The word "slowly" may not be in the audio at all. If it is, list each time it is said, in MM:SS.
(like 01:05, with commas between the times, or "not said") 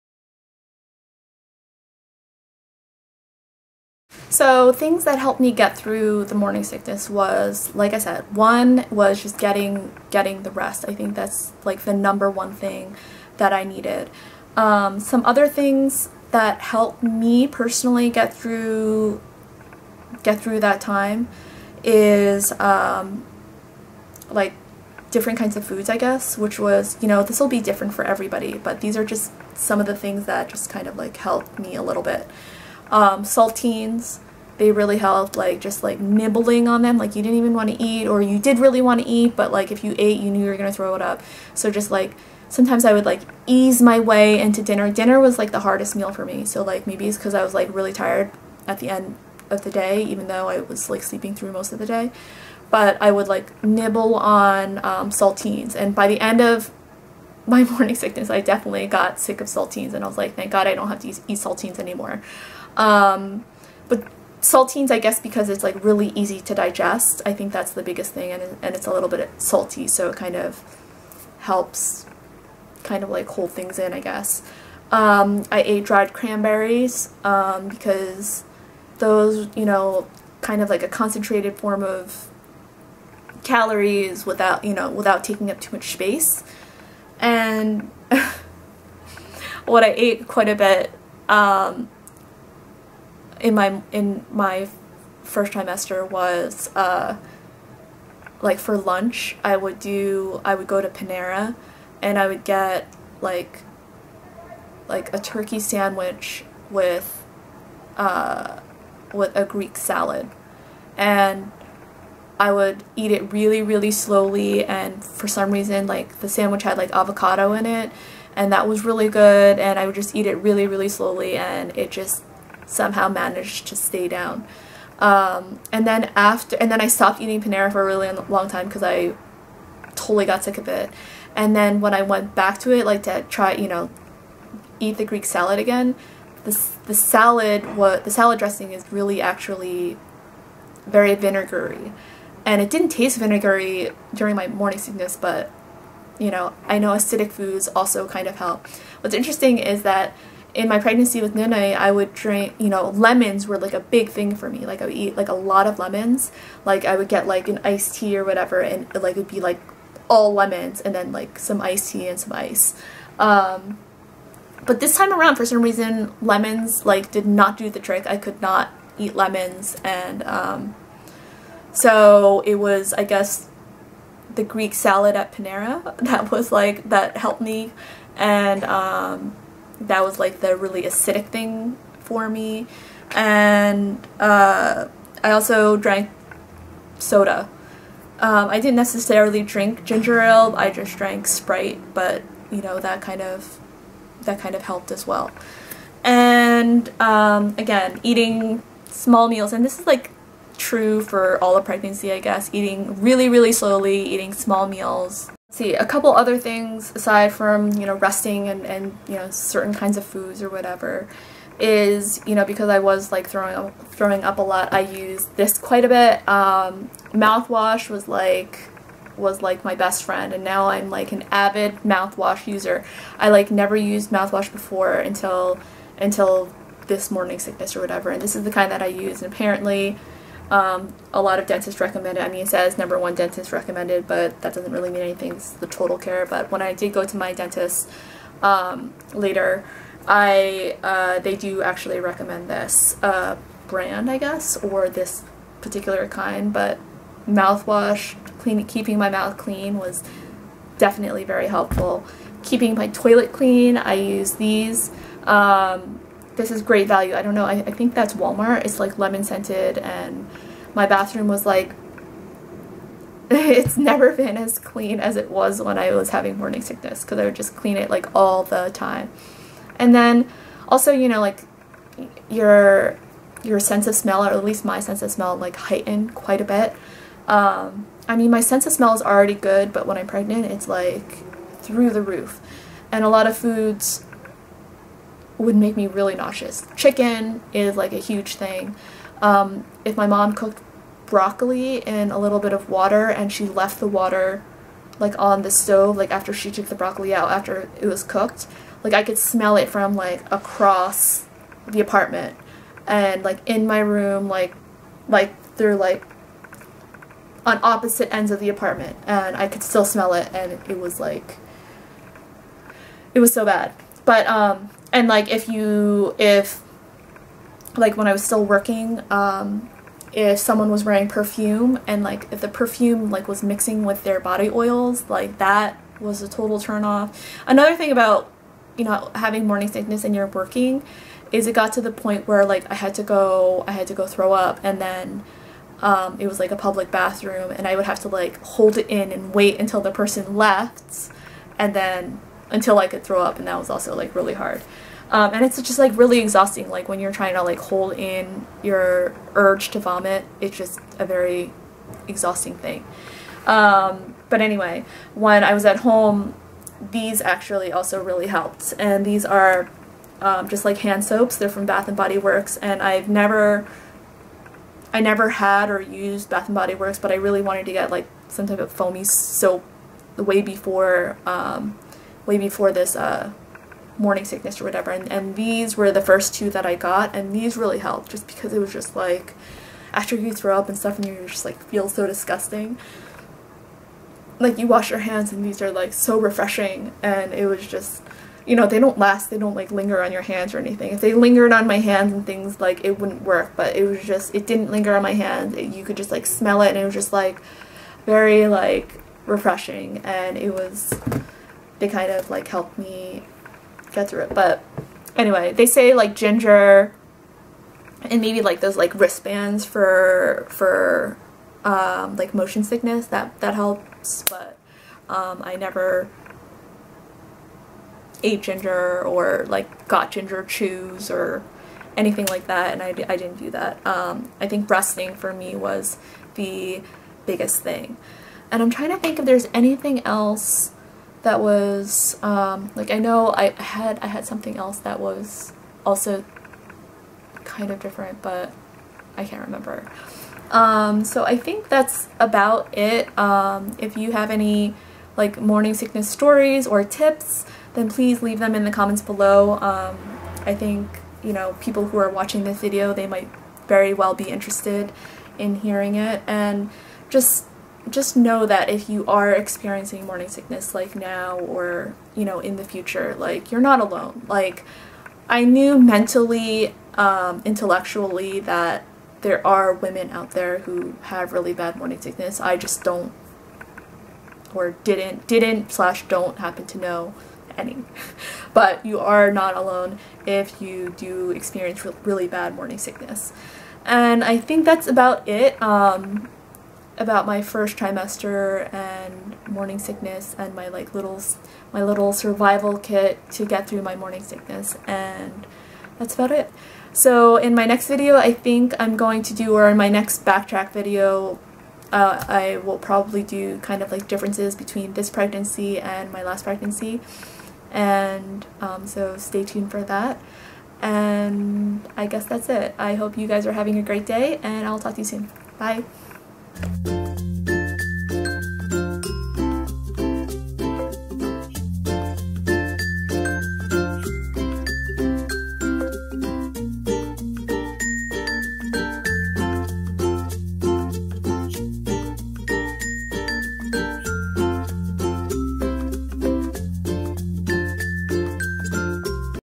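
01:53, 02:00, 03:23.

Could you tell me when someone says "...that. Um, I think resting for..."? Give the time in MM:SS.
07:03.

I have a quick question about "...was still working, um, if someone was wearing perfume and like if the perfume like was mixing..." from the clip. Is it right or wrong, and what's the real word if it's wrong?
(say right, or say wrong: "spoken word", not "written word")
right.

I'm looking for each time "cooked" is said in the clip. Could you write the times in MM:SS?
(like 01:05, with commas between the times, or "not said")
04:50, 04:58.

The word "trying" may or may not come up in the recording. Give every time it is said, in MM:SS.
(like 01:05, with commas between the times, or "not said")
05:47, 07:08.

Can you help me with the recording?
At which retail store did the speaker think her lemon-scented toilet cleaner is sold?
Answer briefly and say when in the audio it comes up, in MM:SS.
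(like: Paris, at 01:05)
Walmart, at 04:18.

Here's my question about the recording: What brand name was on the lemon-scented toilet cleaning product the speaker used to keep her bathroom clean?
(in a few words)
Great Value.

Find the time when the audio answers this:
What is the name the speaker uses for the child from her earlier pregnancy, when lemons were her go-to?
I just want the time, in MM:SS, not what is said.
02:31.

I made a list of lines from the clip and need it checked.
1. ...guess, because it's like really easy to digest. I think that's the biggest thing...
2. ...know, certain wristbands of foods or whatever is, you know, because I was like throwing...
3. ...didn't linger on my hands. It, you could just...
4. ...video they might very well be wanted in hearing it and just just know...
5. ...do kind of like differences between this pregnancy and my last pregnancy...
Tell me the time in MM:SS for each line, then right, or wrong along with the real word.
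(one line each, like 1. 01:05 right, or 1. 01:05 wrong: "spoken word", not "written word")
1. 01:04 right
2. 03:29 wrong: "kinds", not "wristbands"
3. 06:34 right
4. 07:32 wrong: "interested", not "wanted"
5. 08:23 right.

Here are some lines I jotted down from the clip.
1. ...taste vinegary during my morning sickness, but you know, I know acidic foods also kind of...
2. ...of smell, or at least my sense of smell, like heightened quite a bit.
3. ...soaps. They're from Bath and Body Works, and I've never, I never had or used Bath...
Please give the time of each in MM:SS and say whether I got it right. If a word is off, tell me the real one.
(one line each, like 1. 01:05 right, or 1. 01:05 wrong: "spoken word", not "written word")
1. 02:22 right
2. 04:33 right
3. 06:01 right.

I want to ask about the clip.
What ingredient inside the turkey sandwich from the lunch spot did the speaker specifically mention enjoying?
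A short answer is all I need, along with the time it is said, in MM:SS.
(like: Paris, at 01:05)
avocado, at 01:56.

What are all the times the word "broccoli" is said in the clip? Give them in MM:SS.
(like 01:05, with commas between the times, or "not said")
04:51, 04:56.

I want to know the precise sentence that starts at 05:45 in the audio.
Um, and it's just like really exhausting.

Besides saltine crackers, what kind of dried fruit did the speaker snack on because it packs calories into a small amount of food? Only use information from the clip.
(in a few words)
dried cranberries.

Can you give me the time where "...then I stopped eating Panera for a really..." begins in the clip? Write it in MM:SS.
02:06.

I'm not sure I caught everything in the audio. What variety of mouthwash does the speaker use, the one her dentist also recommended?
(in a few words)
Total Care.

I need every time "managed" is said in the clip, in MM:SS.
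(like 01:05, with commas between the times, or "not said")
02:03.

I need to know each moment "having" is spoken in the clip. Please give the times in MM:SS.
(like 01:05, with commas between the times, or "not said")
04:26, 05:29, 08:33.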